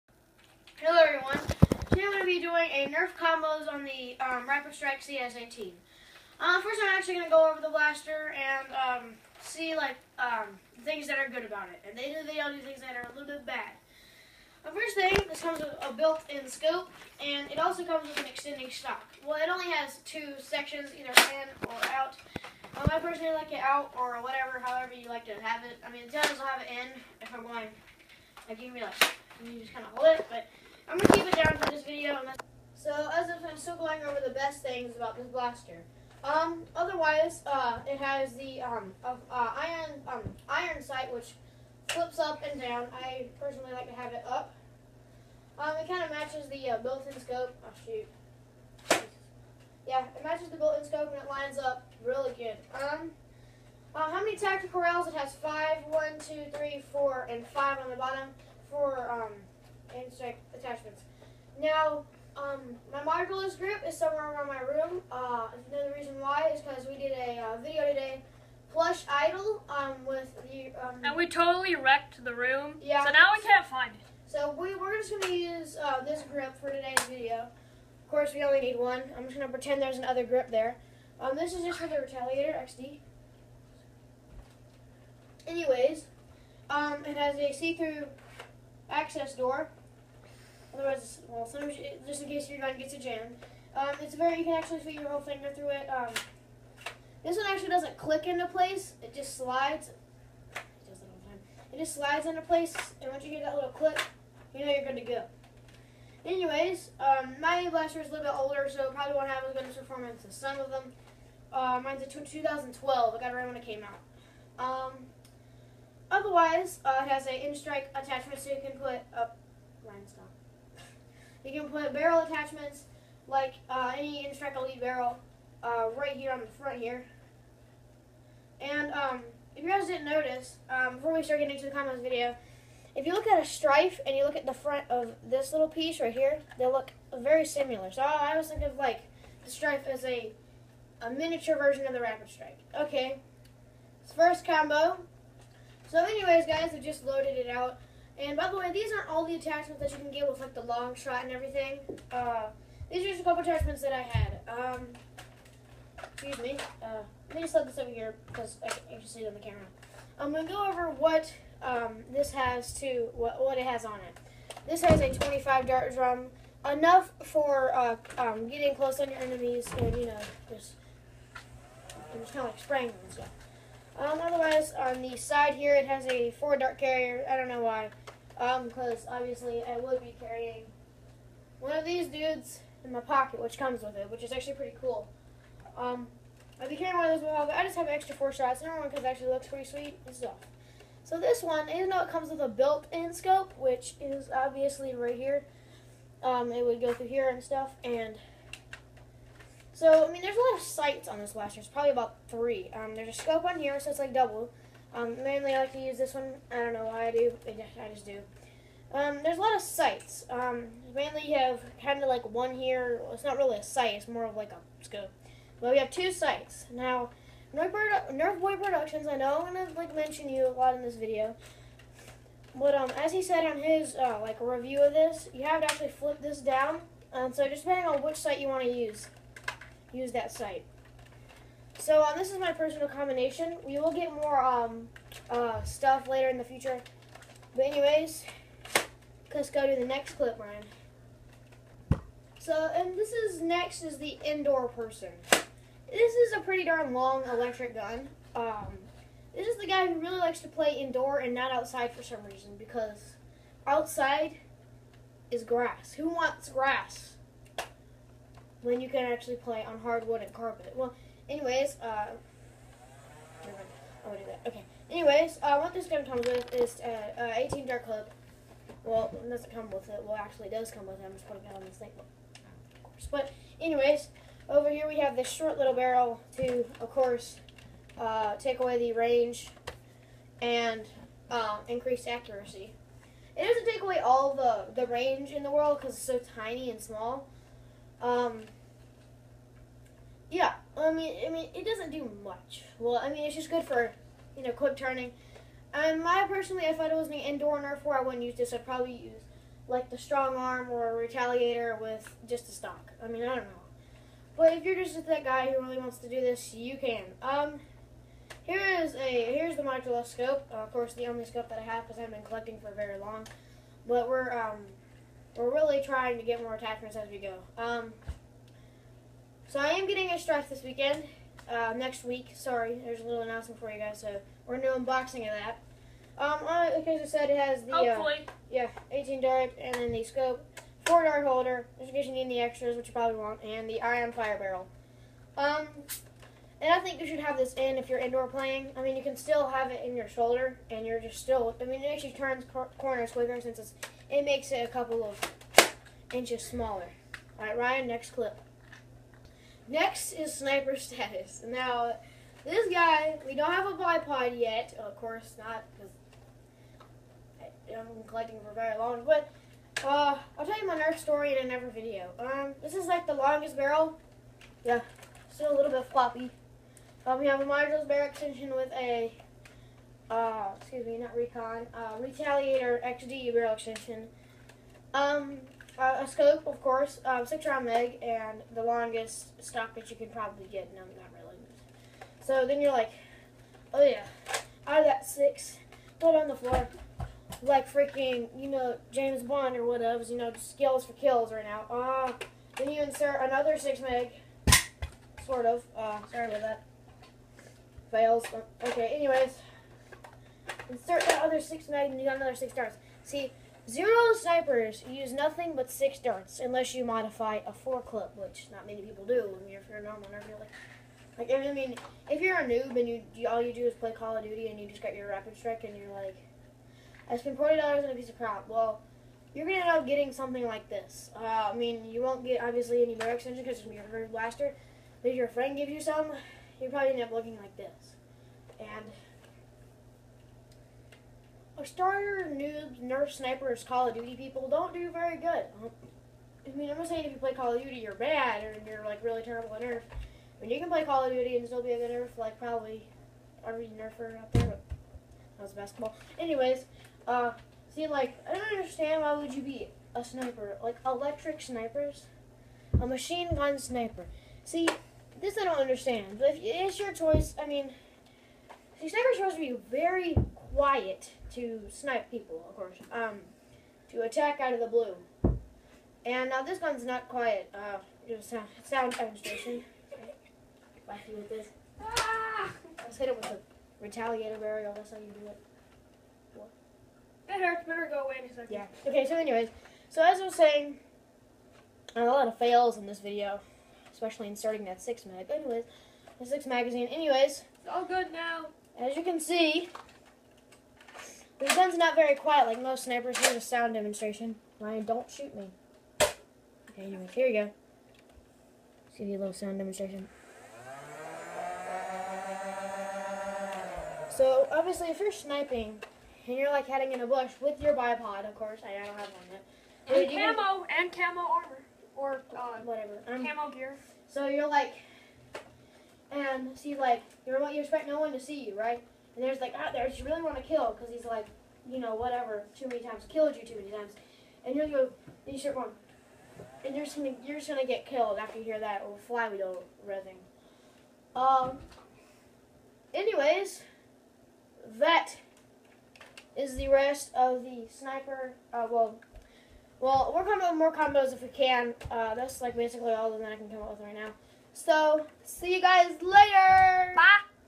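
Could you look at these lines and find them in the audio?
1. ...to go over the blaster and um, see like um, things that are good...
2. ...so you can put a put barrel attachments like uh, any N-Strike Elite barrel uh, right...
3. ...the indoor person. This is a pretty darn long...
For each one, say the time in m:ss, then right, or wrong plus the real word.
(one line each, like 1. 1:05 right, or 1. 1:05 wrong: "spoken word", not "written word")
1. 0:07 right
2. 1:58 right
3. 4:03 right.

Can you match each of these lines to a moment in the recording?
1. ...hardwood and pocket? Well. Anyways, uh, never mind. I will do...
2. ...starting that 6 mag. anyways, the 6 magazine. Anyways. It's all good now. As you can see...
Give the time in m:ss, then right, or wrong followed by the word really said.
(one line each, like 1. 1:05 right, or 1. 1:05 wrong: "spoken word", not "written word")
1. 4:19 wrong: "carpet", not "pocket"
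2. 8:04 right.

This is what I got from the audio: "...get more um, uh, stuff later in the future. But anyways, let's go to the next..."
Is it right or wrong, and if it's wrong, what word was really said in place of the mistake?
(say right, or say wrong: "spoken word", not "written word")
right.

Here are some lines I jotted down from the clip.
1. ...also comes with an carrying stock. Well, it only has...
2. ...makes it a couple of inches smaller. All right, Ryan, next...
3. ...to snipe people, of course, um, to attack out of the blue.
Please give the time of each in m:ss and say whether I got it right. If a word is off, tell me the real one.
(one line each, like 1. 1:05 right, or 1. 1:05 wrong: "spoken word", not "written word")
1. 0:17 wrong: "extending", not "carrying"
2. 5:44 right
3. 7:41 right.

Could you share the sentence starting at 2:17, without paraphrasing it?
So I always think of like the Stryfe as a, a miniature version of the Rapidstrike.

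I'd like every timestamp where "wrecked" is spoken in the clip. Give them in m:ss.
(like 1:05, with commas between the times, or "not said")
1:11.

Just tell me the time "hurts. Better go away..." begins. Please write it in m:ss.
7:57.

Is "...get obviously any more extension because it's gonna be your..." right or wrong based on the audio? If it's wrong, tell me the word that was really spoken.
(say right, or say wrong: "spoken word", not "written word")
right.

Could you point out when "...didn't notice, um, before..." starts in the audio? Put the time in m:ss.
2:09.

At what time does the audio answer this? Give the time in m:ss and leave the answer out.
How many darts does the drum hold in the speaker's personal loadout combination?
2:45.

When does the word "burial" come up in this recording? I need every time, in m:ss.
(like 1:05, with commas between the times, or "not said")
7:54.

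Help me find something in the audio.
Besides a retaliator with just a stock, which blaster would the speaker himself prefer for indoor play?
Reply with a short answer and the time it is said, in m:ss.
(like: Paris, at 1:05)
Strong Arm, at 4:59.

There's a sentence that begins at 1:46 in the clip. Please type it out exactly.
Anyways, um, my blaster is a little bit older, so it probably won't have as good a performance as some of them.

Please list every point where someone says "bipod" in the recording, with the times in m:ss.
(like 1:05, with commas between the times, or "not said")
5:53, 8:27.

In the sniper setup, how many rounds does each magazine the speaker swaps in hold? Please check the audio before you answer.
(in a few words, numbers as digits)
6.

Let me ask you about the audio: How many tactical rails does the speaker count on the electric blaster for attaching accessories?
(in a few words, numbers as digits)
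5.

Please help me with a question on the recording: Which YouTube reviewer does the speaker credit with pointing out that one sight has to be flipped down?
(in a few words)
Nerf Boy Productions.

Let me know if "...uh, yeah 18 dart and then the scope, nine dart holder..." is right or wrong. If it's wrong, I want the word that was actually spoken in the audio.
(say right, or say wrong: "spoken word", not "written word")
wrong: "four", not "nine".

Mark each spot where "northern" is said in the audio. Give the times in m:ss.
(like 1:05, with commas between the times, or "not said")
not said.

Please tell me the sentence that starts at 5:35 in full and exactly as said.
Um, and I think you should have this in if you're indoor playing.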